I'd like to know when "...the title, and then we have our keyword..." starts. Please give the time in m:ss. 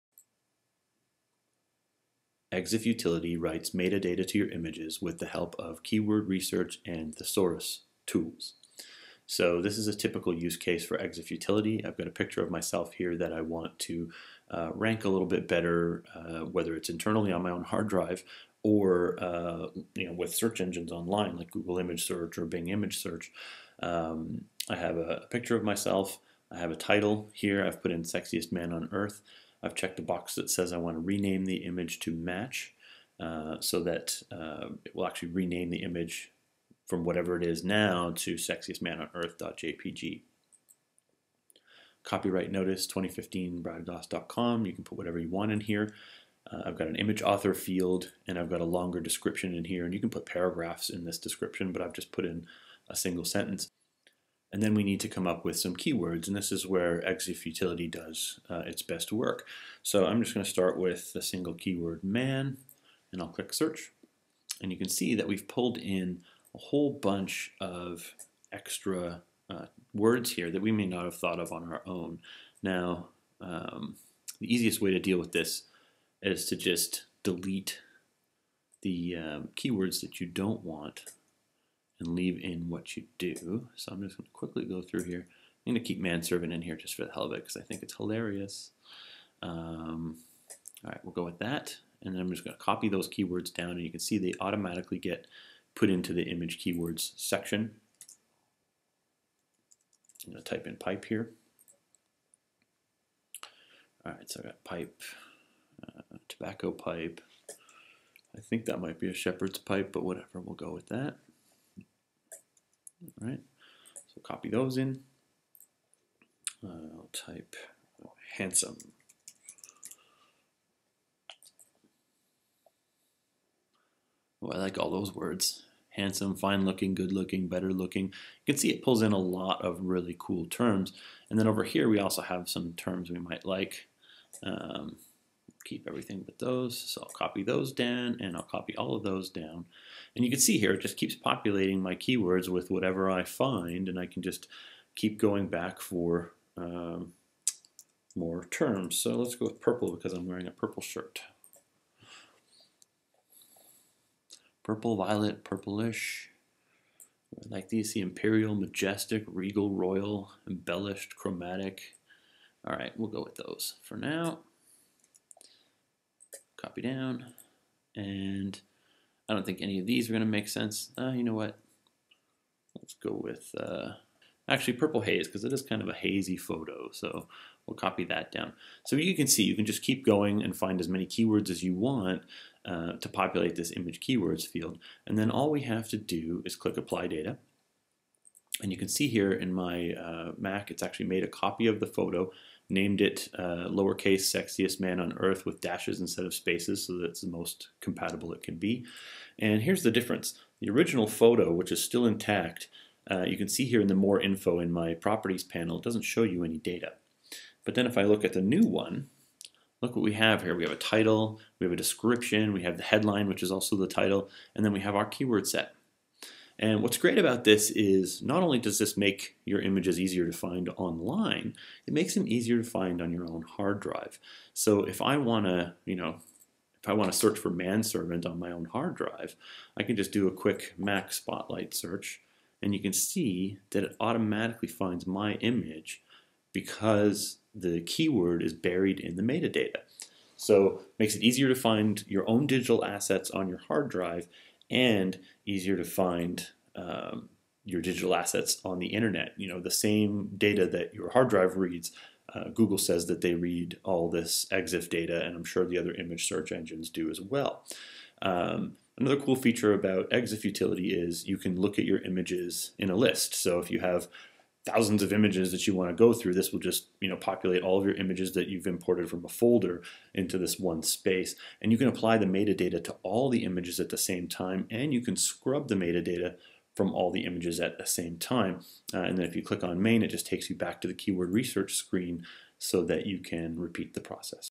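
3:33.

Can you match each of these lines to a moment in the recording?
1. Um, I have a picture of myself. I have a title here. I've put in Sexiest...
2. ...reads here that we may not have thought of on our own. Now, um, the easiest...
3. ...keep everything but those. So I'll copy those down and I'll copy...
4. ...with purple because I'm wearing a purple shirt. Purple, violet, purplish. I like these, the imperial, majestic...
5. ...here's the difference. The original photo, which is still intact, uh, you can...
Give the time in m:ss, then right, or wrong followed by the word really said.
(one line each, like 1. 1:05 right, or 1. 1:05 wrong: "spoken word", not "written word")
1. 0:23 right
2. 1:09 wrong: "words", not "reads"
3. 2:15 right
4. 2:29 right
5. 3:19 right.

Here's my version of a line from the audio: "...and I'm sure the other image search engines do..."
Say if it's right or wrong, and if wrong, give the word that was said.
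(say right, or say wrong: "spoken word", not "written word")
right.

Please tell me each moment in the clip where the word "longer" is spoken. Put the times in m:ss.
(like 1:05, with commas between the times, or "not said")
0:48.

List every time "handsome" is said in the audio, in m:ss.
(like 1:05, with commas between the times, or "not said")
1:58, 2:05.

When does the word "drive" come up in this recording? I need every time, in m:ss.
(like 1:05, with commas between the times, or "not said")
0:17, 3:43, 3:48, 4:03, 4:11.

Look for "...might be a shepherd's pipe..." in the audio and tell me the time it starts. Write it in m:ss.
1:48.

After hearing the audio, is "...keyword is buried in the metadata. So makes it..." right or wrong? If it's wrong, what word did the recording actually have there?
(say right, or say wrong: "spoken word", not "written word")
right.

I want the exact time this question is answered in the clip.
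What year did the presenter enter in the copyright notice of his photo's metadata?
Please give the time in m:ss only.
0:42.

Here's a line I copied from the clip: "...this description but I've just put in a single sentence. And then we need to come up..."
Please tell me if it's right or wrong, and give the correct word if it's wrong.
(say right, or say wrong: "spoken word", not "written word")
right.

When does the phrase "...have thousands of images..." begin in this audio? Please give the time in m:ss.
4:23.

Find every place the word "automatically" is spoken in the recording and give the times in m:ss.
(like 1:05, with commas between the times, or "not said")
1:34, 3:53.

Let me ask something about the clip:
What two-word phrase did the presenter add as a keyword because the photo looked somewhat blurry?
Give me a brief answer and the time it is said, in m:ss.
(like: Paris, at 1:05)
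purple haze, at 2:54.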